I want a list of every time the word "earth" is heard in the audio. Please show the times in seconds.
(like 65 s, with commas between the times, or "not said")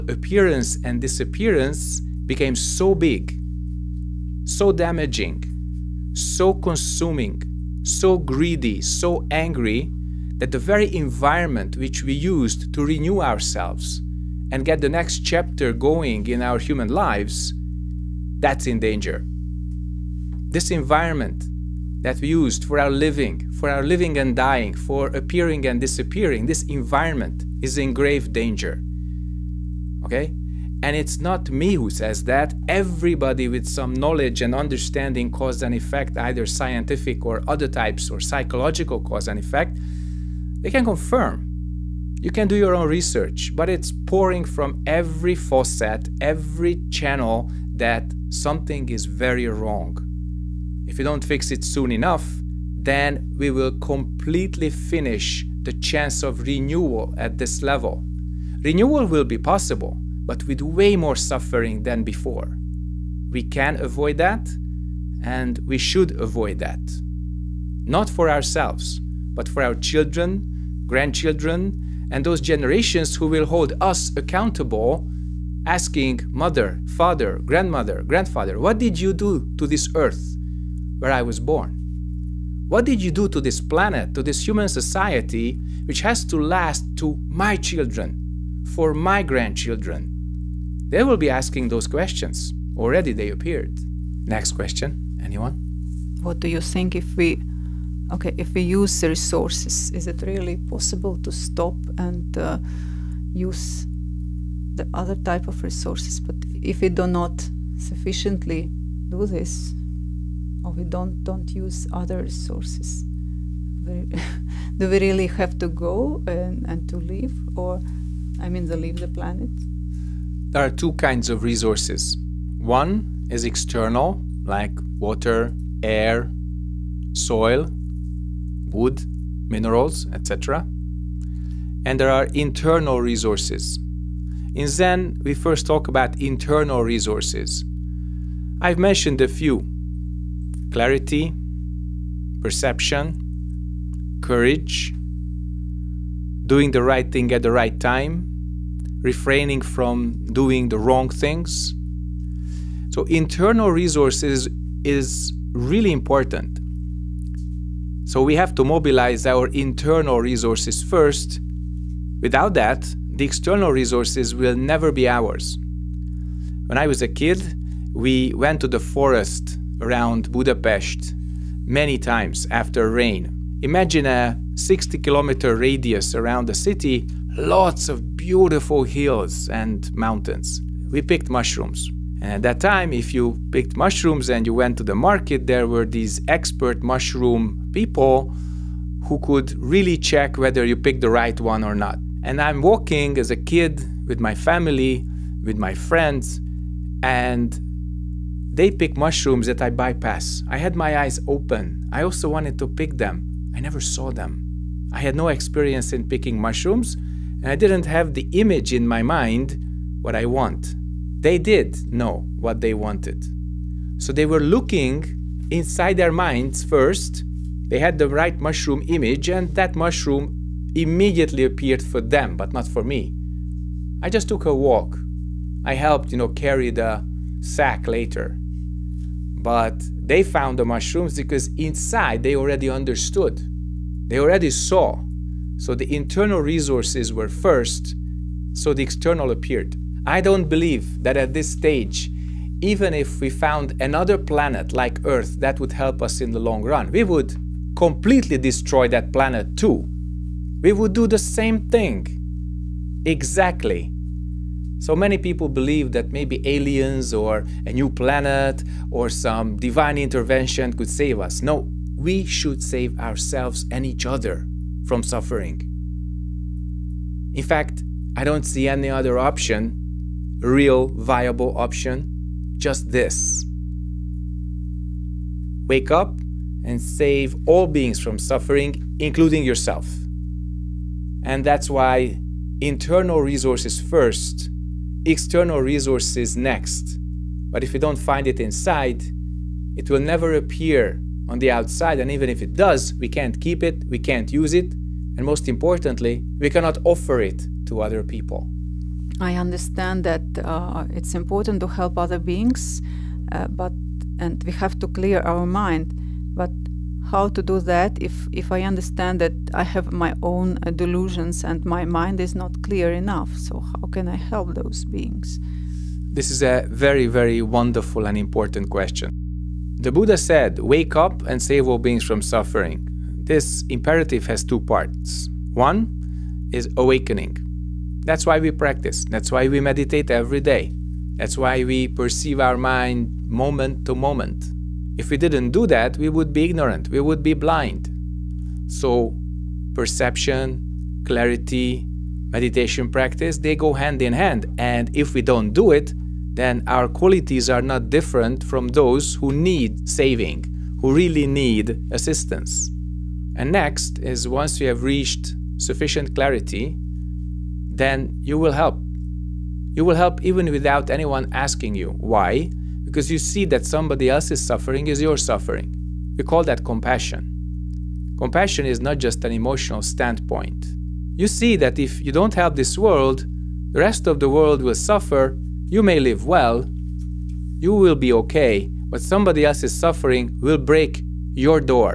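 79 s, 245 s.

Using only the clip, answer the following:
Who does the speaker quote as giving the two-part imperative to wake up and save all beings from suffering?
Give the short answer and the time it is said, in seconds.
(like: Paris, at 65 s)
The Buddha, at 319 s.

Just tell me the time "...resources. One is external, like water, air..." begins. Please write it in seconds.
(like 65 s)
121 s.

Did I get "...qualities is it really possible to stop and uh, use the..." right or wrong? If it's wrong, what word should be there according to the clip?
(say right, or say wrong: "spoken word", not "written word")
wrong: "resources", not "qualities".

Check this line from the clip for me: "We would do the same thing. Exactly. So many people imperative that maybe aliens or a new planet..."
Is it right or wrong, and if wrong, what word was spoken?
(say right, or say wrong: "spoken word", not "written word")
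wrong: "believe", not "imperative".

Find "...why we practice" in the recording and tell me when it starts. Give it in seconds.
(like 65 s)
328 s.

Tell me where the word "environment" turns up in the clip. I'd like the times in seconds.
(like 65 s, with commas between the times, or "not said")
10 s, 20 s, 26 s.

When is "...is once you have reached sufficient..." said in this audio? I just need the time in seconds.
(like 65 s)
353 s.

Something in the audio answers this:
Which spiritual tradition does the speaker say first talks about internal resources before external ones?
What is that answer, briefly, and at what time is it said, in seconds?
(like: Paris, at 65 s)
Zen, at 134 s.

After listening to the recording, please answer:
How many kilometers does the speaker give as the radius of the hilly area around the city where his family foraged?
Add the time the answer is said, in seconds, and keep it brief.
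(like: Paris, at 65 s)
60, at 174 s.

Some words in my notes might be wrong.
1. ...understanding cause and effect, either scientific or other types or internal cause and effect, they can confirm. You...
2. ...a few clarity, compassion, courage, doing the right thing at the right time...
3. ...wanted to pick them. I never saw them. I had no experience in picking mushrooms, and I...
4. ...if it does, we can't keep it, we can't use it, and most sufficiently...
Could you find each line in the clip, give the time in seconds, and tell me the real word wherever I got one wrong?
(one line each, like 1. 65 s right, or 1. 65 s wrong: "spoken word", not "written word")
1. 34 s wrong: "psychological", not "internal"
2. 139 s wrong: "perception", not "compassion"
3. 202 s right
4. 292 s wrong: "importantly", not "sufficiently".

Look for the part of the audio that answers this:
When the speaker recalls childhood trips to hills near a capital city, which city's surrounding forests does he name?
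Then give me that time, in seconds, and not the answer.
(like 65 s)
170 s.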